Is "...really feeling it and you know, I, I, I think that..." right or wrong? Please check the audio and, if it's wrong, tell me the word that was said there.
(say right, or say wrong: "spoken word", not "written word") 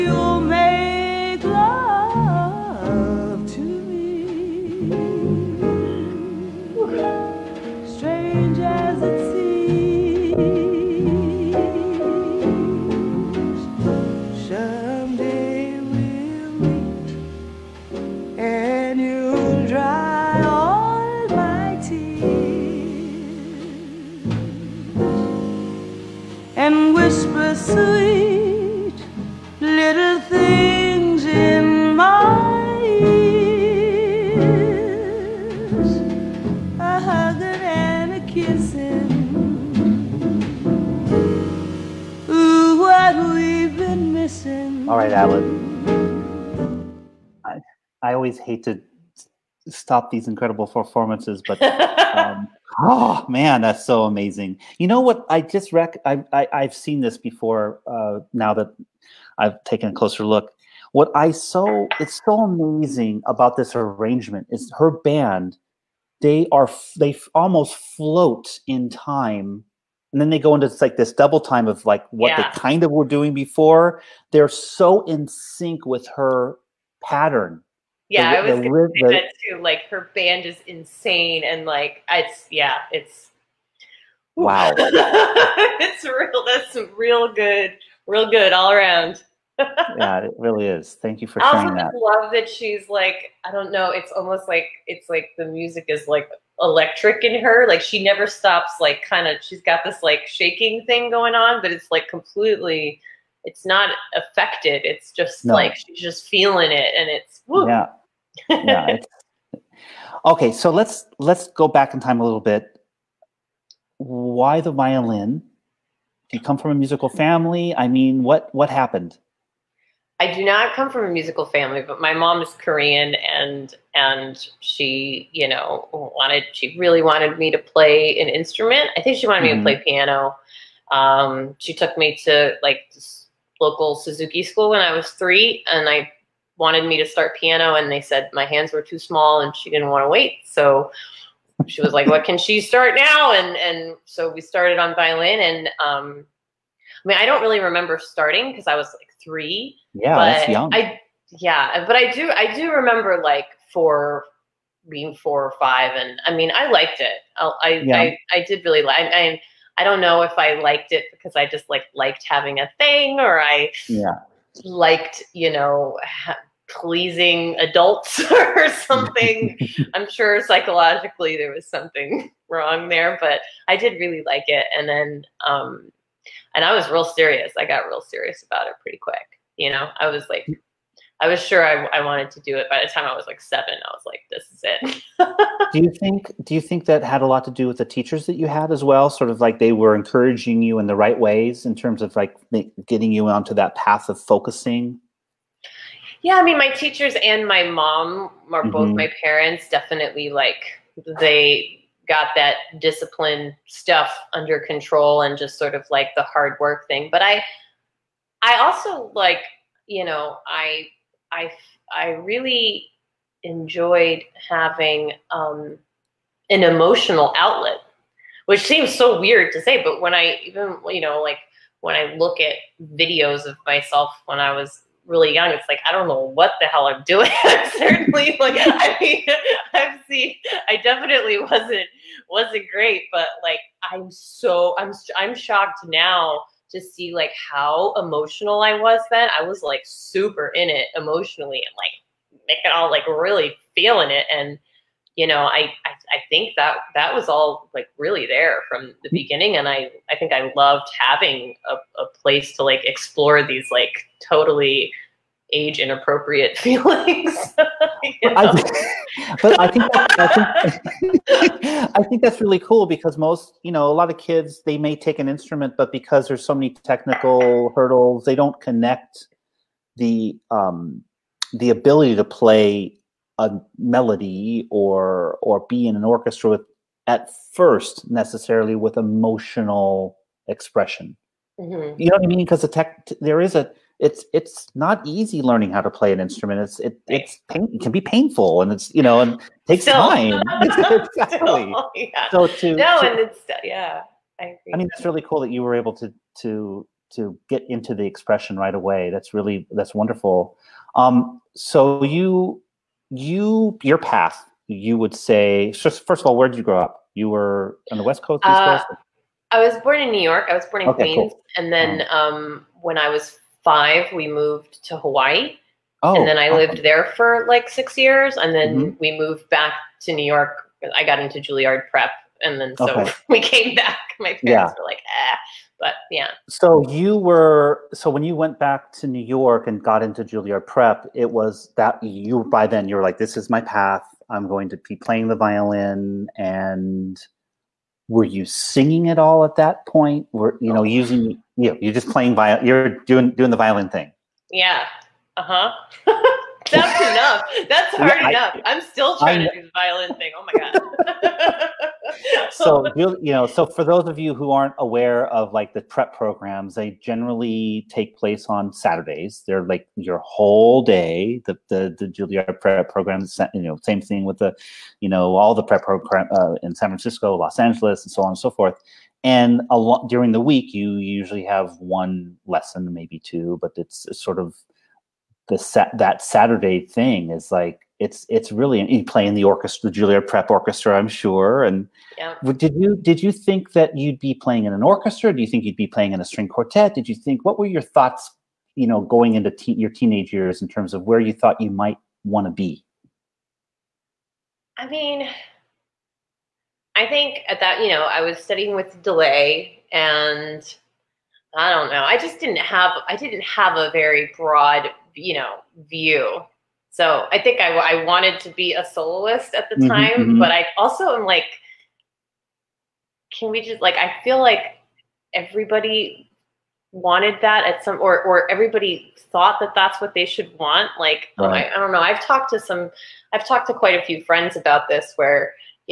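right.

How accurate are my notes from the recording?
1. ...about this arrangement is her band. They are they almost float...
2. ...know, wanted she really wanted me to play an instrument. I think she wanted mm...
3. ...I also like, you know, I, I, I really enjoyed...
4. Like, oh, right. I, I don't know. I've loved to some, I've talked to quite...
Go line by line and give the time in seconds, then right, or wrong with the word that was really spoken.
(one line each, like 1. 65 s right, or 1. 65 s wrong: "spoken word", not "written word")
1. 63 s right
2. 125 s right
3. 208 s right
4. 420 s wrong: "talked", not "loved".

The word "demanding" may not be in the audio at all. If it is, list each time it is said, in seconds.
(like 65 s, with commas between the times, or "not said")
not said.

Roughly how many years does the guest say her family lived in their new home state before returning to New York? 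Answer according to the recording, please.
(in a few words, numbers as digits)
6.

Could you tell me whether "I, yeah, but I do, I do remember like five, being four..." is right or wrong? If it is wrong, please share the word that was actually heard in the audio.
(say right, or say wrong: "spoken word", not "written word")
wrong: "four", not "five".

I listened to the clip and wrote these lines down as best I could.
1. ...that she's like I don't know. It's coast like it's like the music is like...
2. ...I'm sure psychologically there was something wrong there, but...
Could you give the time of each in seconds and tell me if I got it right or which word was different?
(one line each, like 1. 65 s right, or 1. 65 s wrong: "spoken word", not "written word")
1. 92 s wrong: "almost", not "coast"
2. 169 s right.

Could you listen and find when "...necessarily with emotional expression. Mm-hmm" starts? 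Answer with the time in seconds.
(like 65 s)
278 s.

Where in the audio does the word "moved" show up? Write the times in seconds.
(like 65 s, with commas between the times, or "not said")
314 s, 319 s.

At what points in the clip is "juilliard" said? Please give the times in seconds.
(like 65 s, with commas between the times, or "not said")
321 s, 330 s, 362 s, 379 s.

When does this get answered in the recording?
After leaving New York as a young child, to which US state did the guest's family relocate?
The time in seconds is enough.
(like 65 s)
314 s.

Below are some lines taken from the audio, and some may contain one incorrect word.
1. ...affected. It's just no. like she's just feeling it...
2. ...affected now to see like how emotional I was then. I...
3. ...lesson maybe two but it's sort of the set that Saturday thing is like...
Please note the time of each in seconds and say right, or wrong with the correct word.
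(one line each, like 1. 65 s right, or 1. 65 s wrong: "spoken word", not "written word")
1. 104 s right
2. 235 s wrong: "shocked", not "affected"
3. 372 s right.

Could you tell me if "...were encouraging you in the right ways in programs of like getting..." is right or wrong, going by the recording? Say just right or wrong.
wrong.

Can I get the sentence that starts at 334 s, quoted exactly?
I'm going to be playing the violin and were you singing at all at that point?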